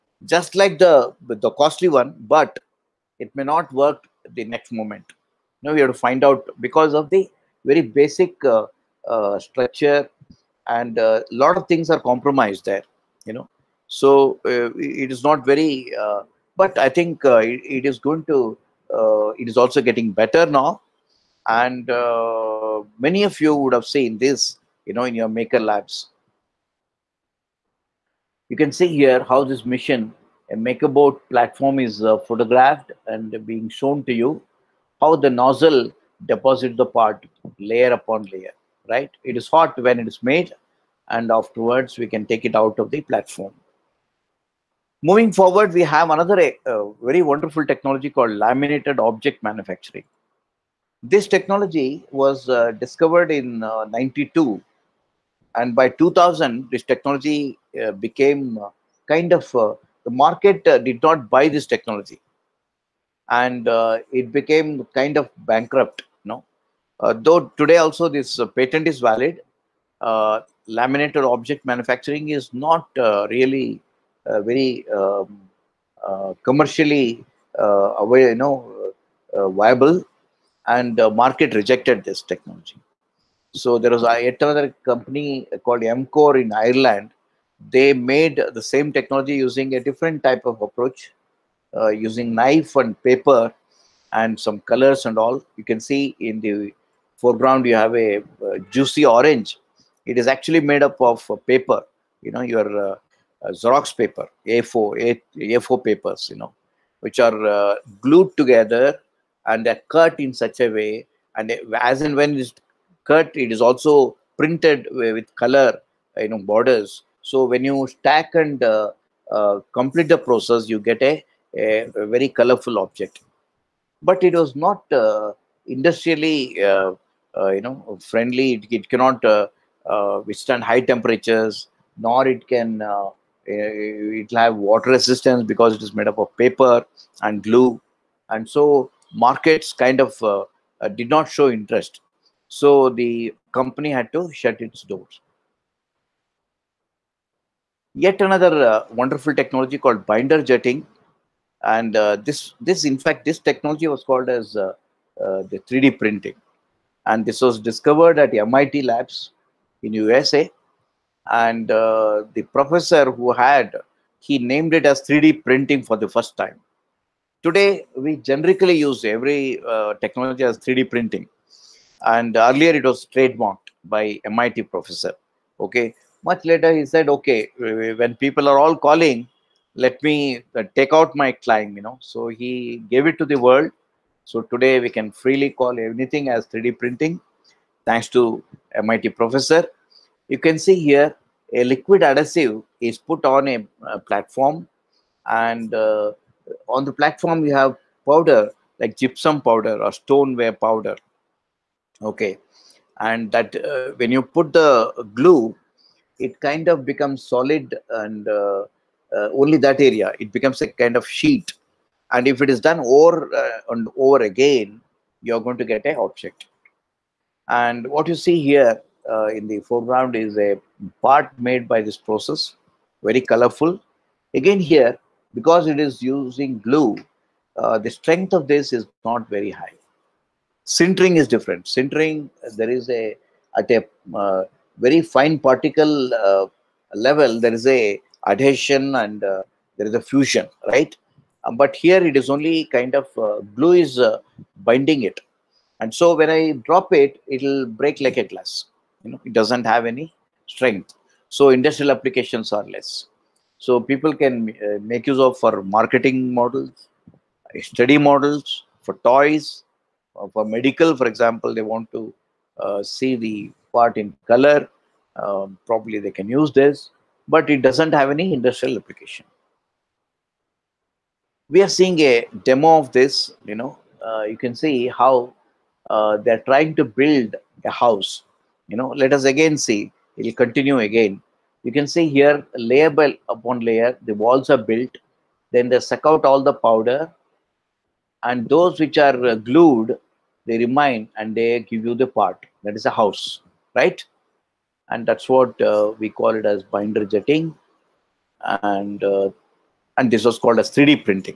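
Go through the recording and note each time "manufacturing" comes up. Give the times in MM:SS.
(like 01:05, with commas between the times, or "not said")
00:49, 01:11.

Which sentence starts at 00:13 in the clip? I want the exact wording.
So uh, it is not very, uh, but I think it, it is going to, it is also getting better now.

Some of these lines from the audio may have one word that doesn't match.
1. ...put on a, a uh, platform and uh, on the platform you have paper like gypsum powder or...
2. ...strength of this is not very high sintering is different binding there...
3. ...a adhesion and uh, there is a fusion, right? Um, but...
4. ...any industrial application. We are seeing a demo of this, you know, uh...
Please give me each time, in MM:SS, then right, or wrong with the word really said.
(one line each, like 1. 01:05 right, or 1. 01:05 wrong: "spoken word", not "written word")
1. 03:13 wrong: "powder", not "paper"
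2. 03:47 wrong: "sintering", not "binding"
3. 03:57 right
4. 04:28 right.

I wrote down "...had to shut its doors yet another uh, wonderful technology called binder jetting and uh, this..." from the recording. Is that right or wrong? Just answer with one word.
right.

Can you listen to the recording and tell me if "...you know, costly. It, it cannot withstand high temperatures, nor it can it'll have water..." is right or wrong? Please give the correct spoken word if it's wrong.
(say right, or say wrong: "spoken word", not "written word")
wrong: "friendly", not "costly".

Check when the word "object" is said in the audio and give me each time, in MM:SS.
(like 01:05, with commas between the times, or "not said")
00:48, 01:11, 02:02, 03:35.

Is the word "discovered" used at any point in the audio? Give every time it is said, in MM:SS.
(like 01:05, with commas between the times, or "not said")
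00:52, 02:37.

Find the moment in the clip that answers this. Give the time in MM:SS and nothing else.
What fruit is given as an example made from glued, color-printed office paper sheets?
01:39.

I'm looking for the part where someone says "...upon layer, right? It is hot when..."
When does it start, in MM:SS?
00:37.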